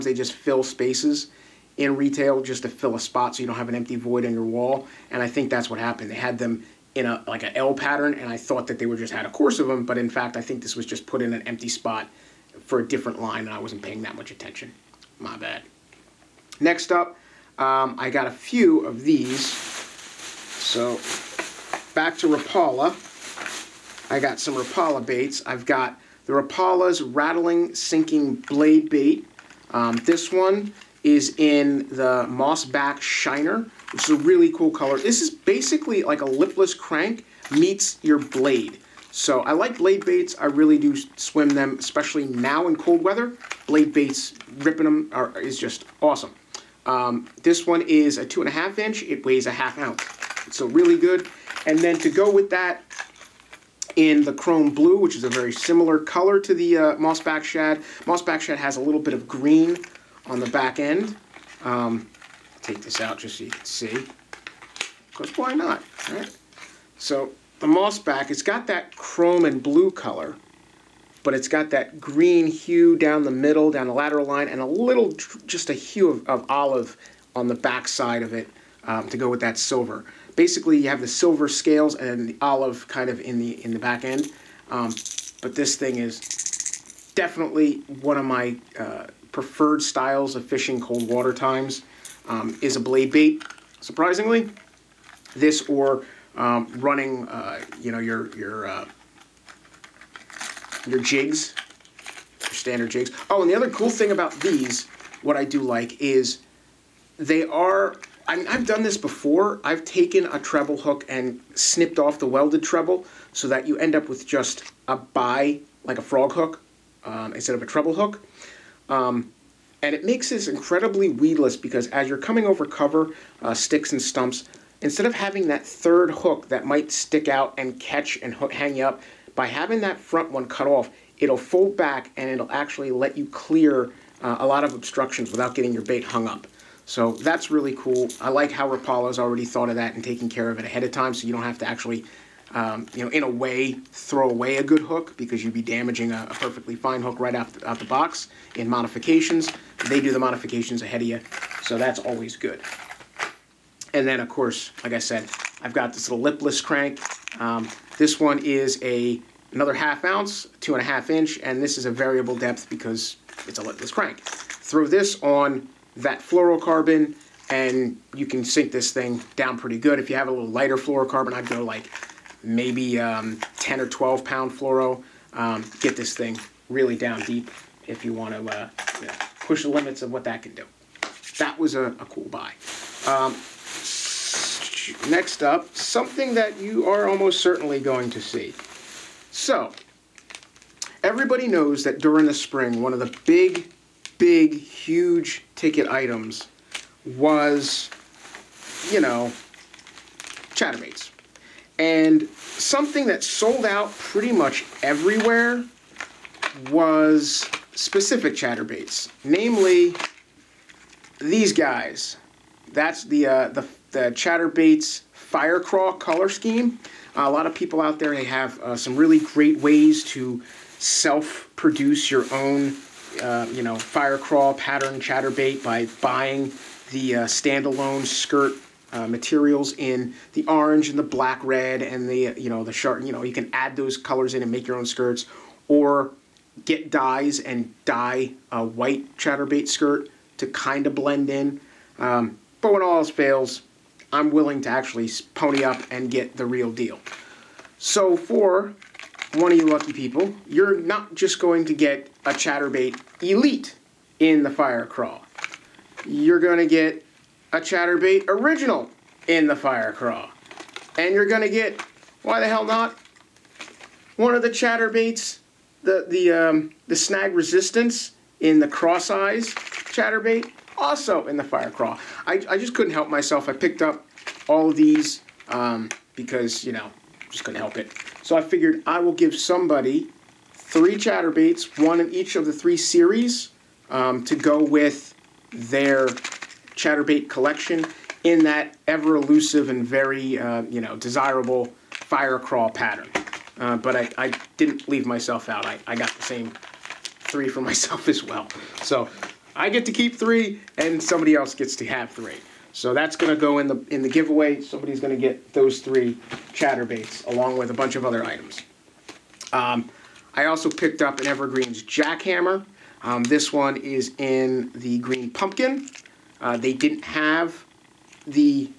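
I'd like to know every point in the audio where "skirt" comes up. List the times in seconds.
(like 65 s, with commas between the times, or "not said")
228 s, 234 s, 239 s.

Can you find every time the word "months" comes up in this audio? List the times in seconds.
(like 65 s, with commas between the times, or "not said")
not said.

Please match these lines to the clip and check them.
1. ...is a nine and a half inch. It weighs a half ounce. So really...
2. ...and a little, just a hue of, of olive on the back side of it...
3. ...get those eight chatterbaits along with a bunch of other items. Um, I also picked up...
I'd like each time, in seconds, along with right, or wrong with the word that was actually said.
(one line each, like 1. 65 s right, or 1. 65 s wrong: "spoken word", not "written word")
1. 47 s wrong: "two", not "nine"
2. 74 s right
3. 305 s wrong: "three", not "eight".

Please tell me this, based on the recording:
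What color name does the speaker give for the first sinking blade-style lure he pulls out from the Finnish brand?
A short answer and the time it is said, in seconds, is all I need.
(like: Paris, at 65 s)
Mossback Shiner, at 32 s.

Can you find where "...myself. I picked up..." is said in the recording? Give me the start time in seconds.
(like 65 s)
273 s.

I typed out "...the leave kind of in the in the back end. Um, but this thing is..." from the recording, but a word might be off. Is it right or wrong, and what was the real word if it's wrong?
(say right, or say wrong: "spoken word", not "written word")
wrong: "olive", not "leave".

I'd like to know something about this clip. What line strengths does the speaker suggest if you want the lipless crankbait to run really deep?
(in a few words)
10 or 12 pound.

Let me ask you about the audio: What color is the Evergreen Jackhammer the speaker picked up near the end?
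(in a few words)
green pumpkin.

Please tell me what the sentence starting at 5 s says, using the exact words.
And I think that's what happened.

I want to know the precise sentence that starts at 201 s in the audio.
And something that sold out pretty much everywhere was specific chatterbaits, namely these guys.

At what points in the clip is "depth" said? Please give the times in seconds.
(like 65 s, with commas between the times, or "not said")
162 s.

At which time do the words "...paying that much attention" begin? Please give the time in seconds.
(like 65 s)
13 s.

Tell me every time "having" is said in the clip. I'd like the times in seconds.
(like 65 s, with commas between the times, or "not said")
125 s, 129 s.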